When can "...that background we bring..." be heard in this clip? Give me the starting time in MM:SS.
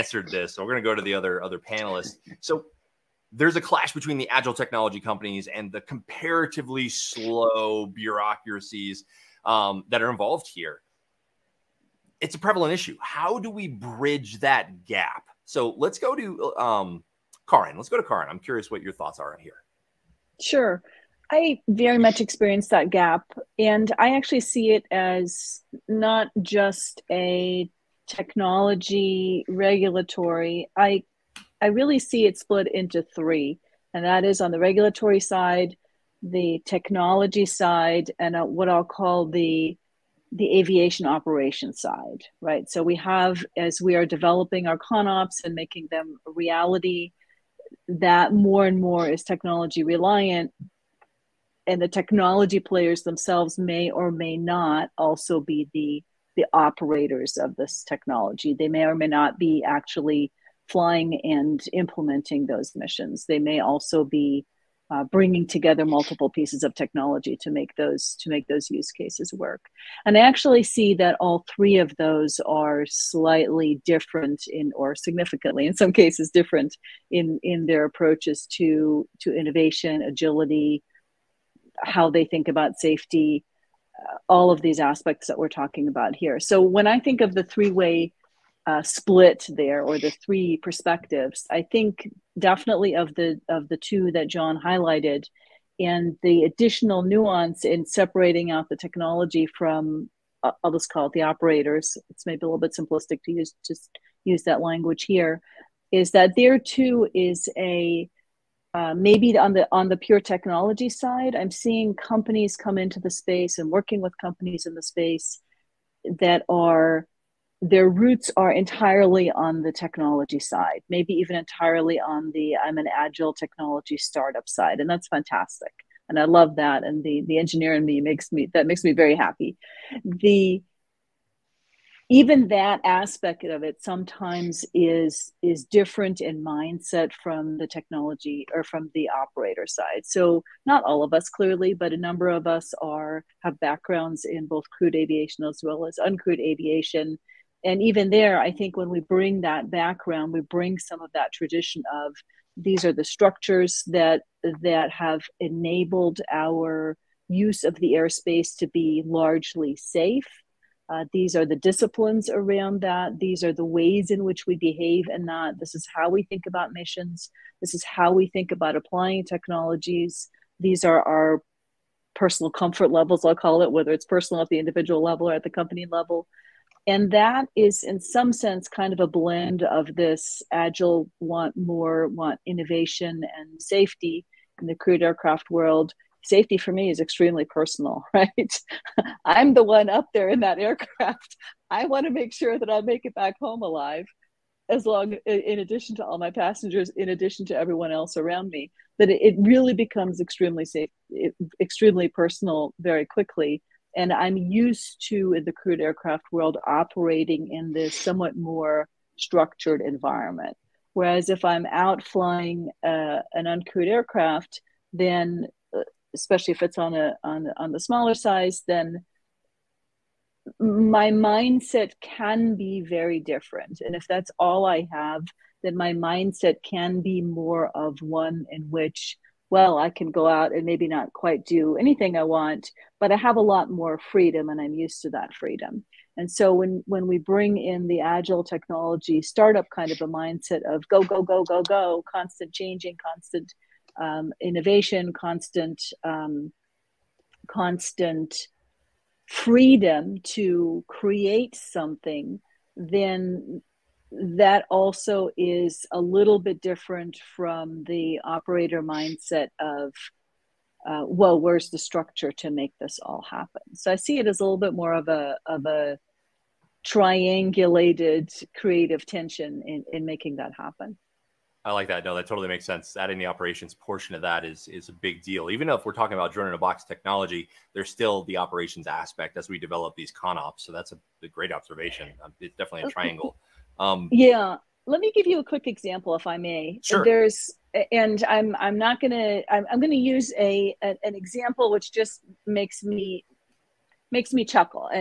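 02:29.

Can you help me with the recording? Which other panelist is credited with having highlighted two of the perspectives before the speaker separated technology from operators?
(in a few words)
John.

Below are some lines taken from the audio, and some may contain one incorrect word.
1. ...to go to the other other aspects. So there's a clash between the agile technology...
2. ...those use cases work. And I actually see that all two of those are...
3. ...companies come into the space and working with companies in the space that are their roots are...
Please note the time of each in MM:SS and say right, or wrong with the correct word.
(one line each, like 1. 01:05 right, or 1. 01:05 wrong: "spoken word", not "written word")
1. 00:00 wrong: "panelists", not "aspects"
2. 01:08 wrong: "three", not "two"
3. 01:51 right.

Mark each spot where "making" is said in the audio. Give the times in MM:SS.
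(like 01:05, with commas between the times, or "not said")
00:45, 04:30.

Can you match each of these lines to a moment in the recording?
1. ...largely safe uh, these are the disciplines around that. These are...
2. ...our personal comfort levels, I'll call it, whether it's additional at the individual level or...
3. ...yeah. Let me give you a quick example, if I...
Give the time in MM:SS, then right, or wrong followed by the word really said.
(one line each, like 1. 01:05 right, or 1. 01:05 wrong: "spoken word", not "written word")
1. 02:39 right
2. 02:51 wrong: "personal", not "additional"
3. 04:44 right.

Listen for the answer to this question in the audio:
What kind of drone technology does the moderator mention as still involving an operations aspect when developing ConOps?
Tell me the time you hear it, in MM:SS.
04:36.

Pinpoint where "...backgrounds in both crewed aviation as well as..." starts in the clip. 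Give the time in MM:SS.
02:23.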